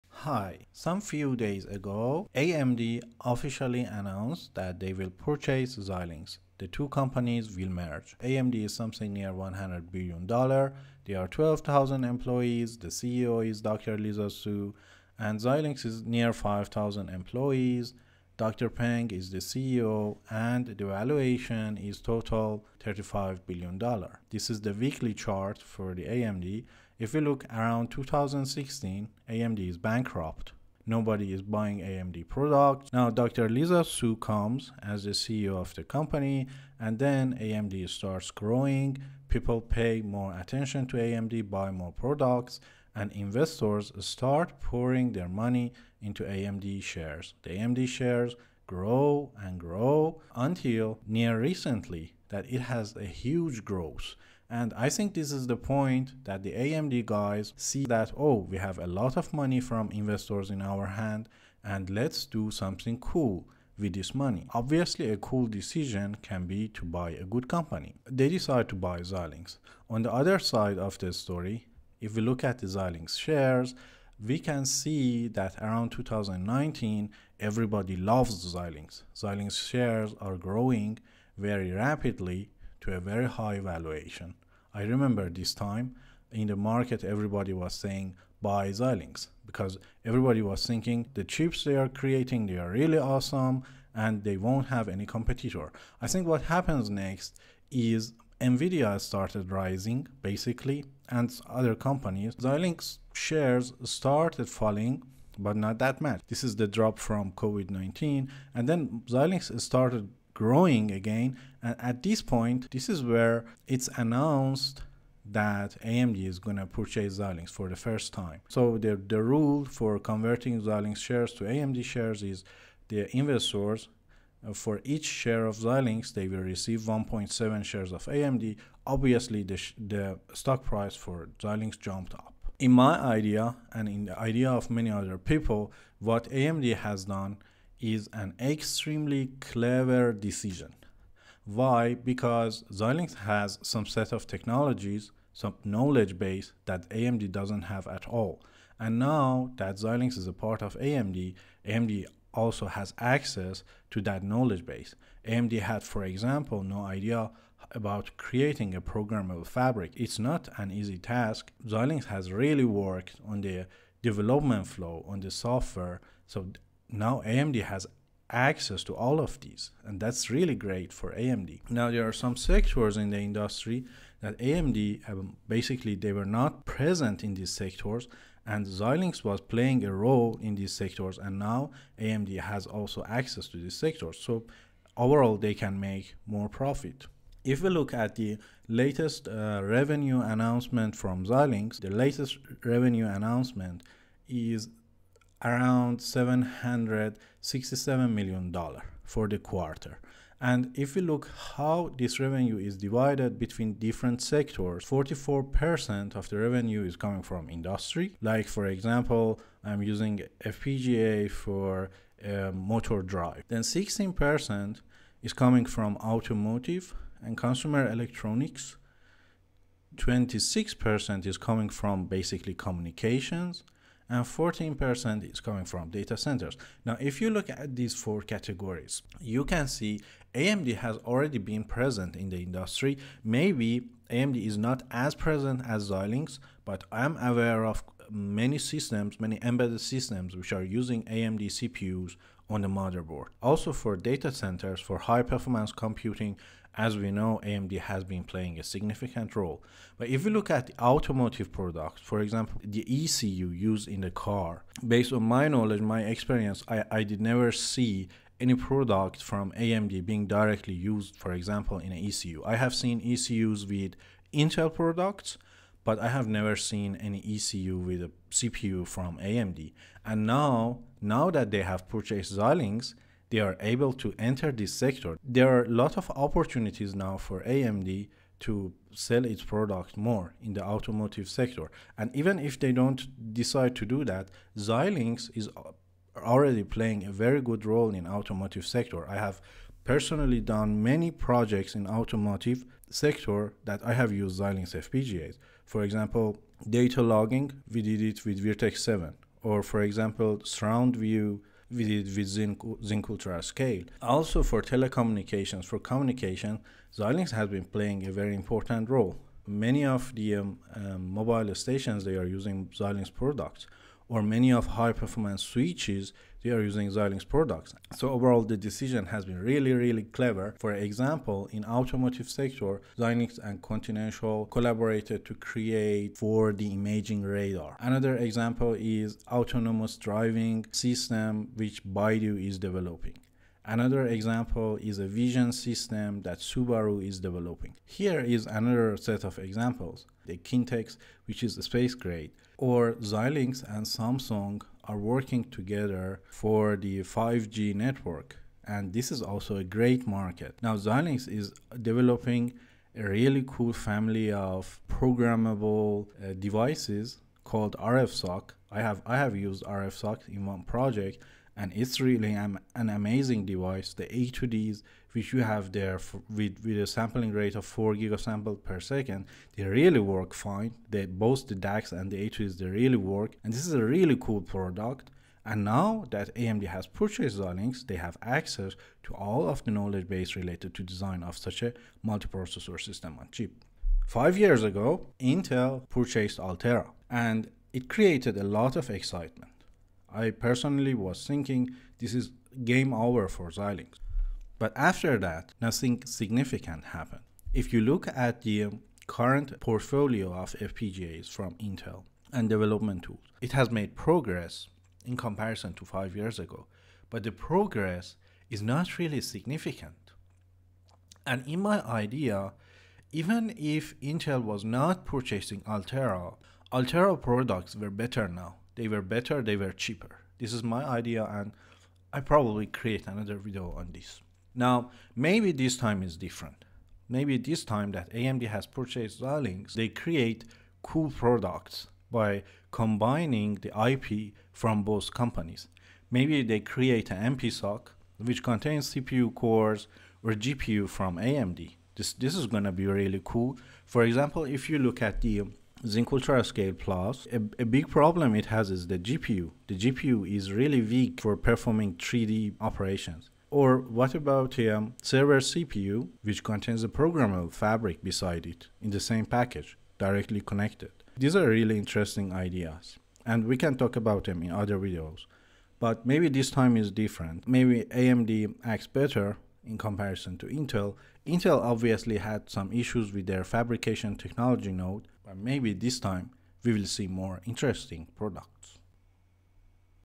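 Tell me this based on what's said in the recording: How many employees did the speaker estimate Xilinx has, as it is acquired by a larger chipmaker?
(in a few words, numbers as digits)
5,000.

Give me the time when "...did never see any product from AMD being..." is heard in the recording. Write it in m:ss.
4:17.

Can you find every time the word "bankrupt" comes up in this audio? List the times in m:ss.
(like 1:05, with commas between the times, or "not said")
0:29.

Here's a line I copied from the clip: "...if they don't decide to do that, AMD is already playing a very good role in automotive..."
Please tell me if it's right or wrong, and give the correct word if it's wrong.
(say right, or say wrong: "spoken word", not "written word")
wrong: "Xilinx", not "AMD".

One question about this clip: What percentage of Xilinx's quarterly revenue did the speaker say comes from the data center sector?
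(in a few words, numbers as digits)
14%.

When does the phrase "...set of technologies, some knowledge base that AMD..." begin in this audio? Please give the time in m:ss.
2:23.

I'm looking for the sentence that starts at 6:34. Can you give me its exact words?
But after that, nothing significant happened.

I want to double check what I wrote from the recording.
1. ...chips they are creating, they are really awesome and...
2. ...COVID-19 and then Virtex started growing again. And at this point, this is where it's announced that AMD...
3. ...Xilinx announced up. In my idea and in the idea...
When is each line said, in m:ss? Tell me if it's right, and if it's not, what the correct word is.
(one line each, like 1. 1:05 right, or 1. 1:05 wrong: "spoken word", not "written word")
1. 1:31 right
2. 1:47 wrong: "Xilinx", not "Virtex"
3. 2:11 wrong: "jumped", not "announced".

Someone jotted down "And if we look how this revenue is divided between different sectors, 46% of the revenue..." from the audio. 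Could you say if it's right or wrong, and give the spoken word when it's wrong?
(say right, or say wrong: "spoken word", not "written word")
wrong: "44", not "46".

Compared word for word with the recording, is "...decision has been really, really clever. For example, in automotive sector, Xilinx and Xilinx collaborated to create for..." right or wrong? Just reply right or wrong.
wrong.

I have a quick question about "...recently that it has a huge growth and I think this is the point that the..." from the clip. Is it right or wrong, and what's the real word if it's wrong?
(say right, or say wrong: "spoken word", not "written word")
right.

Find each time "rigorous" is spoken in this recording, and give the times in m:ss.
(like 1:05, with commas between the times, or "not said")
not said.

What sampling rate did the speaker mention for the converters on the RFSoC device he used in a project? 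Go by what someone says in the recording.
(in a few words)
4 gigasamples per second.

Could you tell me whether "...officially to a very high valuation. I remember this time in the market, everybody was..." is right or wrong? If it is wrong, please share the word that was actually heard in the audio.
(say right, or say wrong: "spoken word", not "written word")
wrong: "rapidly", not "officially".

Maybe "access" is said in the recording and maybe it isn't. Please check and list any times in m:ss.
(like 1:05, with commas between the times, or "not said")
2:32, 2:48, 3:03, 6:18.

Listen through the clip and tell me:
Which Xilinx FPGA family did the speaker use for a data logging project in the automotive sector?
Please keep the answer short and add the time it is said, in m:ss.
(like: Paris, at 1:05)
Virtex 7, at 4:58.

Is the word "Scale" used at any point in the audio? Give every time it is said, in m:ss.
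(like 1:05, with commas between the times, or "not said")
5:03, 7:26.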